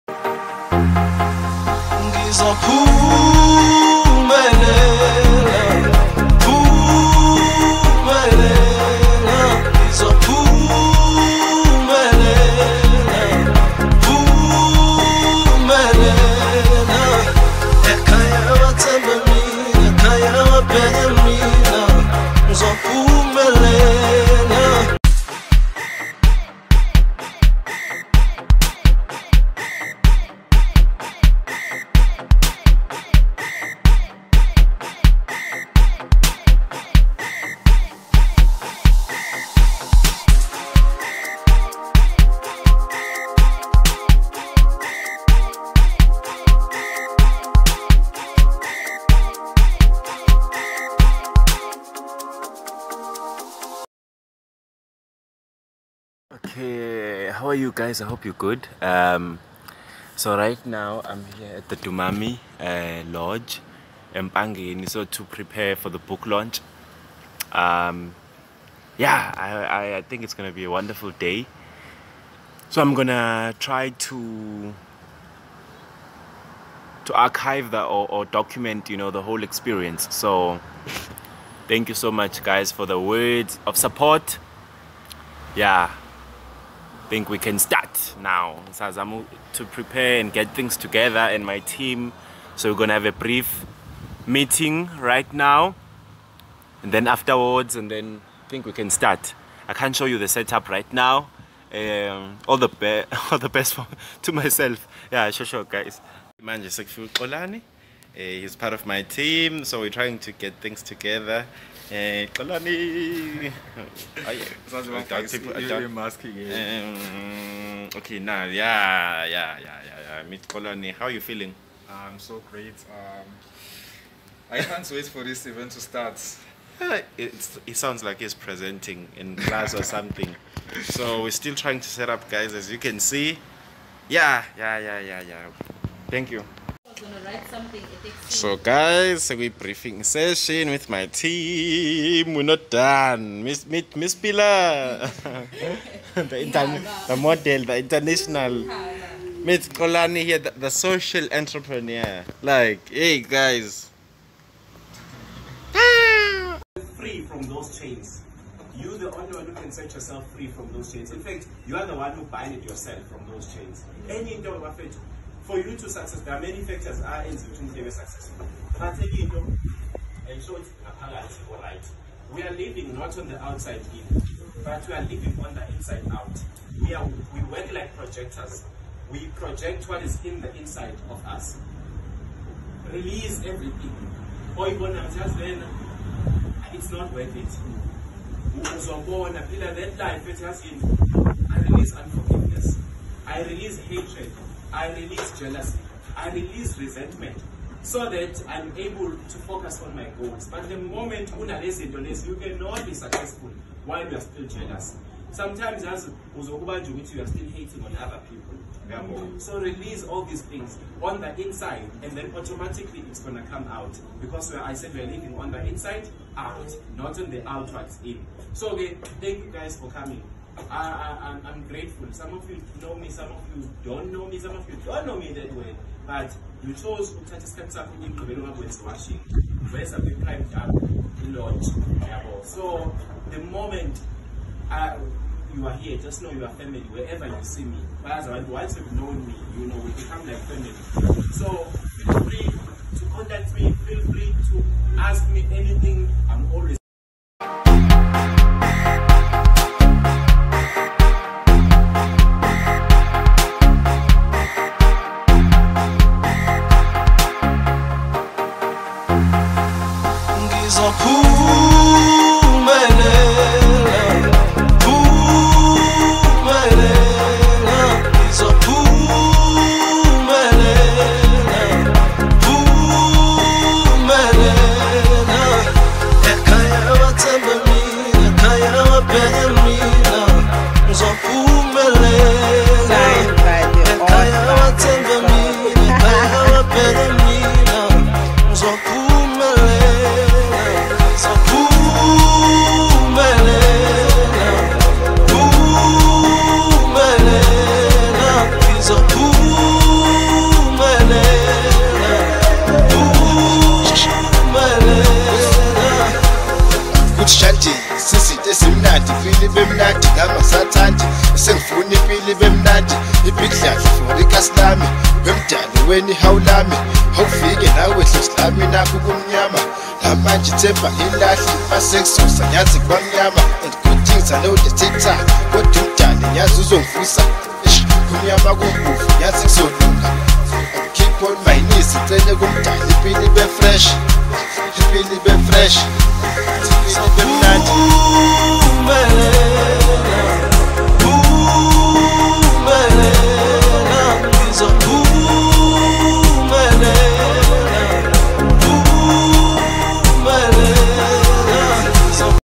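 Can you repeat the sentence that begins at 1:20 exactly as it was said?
So thank you so much, guys, for the words of support.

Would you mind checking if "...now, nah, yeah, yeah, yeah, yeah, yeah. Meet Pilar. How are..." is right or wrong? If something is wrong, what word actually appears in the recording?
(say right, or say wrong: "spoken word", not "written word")
wrong: "Kalani", not "Pilar".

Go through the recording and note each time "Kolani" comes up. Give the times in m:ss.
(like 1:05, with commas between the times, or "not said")
1:47, 2:29.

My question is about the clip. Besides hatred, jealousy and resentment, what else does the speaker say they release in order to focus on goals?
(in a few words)
Unforgiveness.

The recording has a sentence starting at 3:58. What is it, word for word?
But once you've known me, you know, we become like family.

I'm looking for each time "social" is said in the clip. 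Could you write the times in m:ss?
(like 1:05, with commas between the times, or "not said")
2:30.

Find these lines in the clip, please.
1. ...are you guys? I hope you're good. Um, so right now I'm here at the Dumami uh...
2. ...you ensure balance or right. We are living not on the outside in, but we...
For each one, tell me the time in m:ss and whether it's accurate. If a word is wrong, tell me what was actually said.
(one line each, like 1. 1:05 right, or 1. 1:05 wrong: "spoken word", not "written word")
1. 0:57 right
2. 2:49 right.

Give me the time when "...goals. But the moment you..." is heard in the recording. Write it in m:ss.
3:20.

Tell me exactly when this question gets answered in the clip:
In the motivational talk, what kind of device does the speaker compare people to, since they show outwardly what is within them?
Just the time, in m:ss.
2:57.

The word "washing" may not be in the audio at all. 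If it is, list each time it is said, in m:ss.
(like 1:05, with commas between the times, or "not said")
3:48.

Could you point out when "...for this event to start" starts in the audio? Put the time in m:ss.
2:05.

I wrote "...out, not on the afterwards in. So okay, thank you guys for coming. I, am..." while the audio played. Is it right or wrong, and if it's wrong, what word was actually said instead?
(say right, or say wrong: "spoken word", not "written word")
wrong: "outwards", not "afterwards".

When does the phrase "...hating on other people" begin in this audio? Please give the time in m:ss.
3:27.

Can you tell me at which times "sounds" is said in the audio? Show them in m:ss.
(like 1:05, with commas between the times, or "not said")
1:54, 2:07.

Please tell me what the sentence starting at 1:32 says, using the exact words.
So we're gonna have a brief meeting right now.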